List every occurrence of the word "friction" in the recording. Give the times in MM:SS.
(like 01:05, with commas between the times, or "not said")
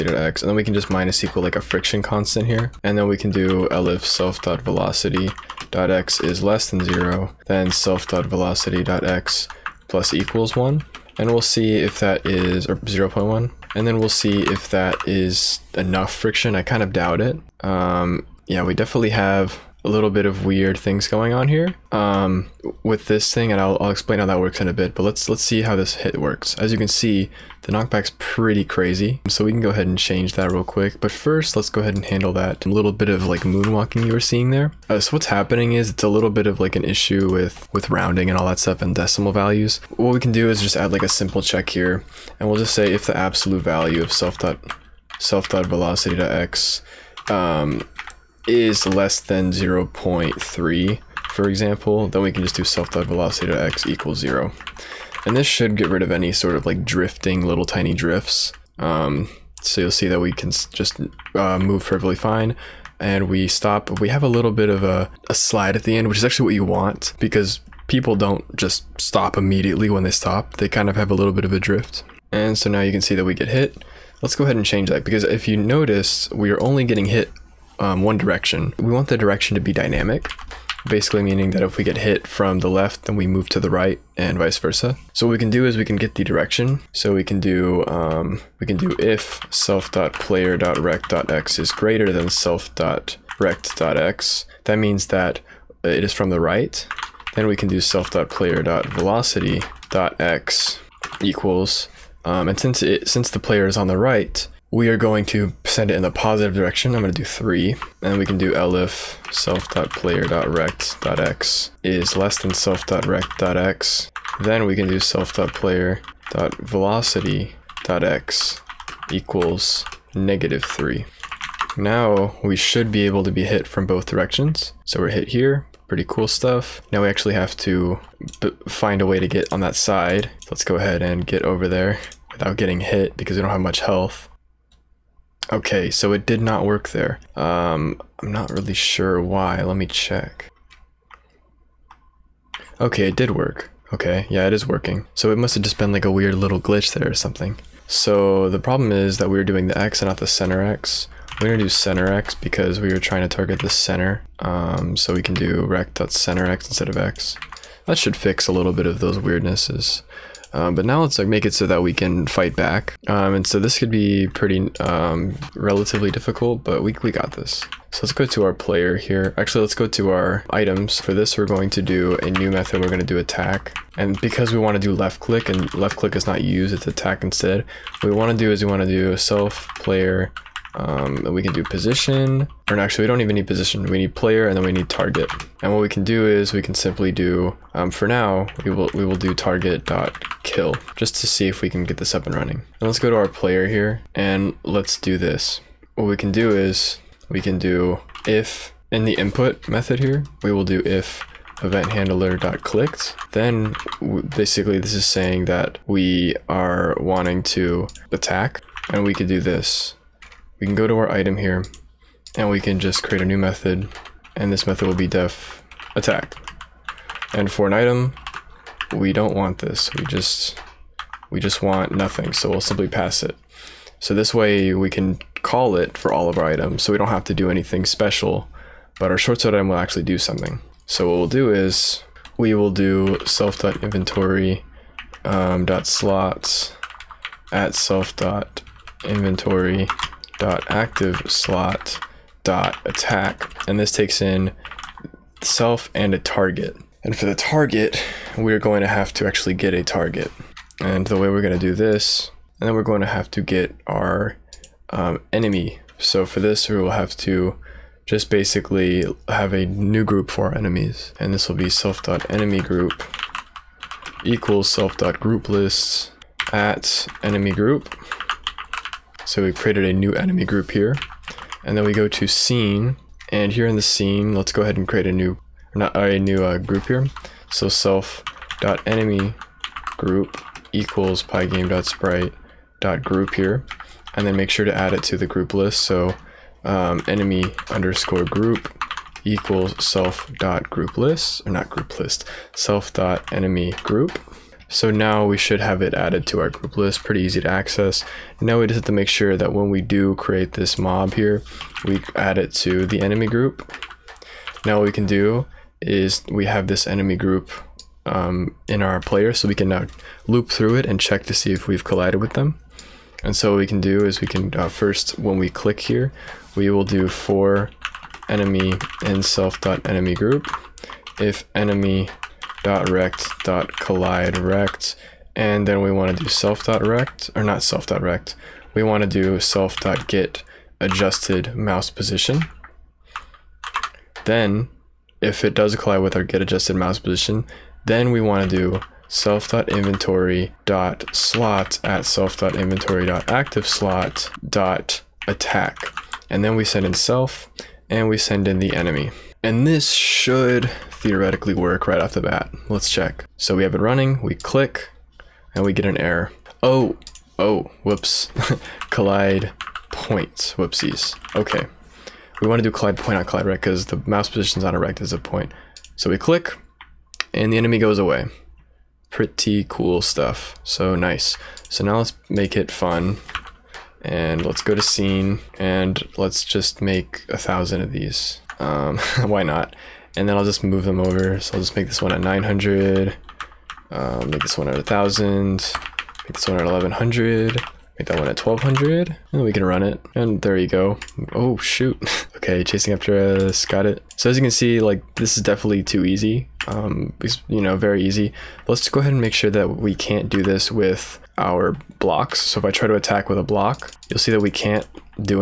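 00:01, 00:16.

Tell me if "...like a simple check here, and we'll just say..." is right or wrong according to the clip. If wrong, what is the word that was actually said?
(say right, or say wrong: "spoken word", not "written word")
right.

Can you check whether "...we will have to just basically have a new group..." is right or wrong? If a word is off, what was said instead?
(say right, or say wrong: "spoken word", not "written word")
right.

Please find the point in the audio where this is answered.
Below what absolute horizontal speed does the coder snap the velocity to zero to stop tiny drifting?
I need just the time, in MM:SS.
00:49.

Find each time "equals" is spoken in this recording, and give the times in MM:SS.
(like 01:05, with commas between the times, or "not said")
00:01, 00:10, 00:53, 01:41, 01:59, 04:24, 04:40, 04:49.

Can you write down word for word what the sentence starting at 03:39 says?
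We just we just want nothing, so we'll simply pass it.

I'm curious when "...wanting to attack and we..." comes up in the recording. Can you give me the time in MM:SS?
03:26.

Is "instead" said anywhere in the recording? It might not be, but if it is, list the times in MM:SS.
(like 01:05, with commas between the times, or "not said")
02:36, 02:57.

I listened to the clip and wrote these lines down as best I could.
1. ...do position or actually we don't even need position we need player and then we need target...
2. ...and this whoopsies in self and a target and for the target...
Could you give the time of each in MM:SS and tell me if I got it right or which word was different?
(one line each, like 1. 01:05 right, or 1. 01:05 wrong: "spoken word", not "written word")
1. 03:01 right
2. 04:03 wrong: "takes", not "whoopsies".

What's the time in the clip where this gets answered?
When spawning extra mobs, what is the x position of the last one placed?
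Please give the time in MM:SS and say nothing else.
06:28.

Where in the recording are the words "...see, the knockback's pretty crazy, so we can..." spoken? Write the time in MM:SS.
00:26.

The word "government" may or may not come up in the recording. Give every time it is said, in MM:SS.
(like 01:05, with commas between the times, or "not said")
not said.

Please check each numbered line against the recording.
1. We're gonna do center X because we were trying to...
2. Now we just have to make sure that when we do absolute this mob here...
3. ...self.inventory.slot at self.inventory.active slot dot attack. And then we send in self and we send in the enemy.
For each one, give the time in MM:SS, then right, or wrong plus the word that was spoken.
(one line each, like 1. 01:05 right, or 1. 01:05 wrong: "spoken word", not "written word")
1. 02:31 right
2. 04:58 wrong: "create", not "absolute"
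3. 05:39 right.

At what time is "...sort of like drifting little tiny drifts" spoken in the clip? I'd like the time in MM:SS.
00:56.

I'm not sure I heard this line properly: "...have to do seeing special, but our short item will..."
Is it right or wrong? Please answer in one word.
wrong.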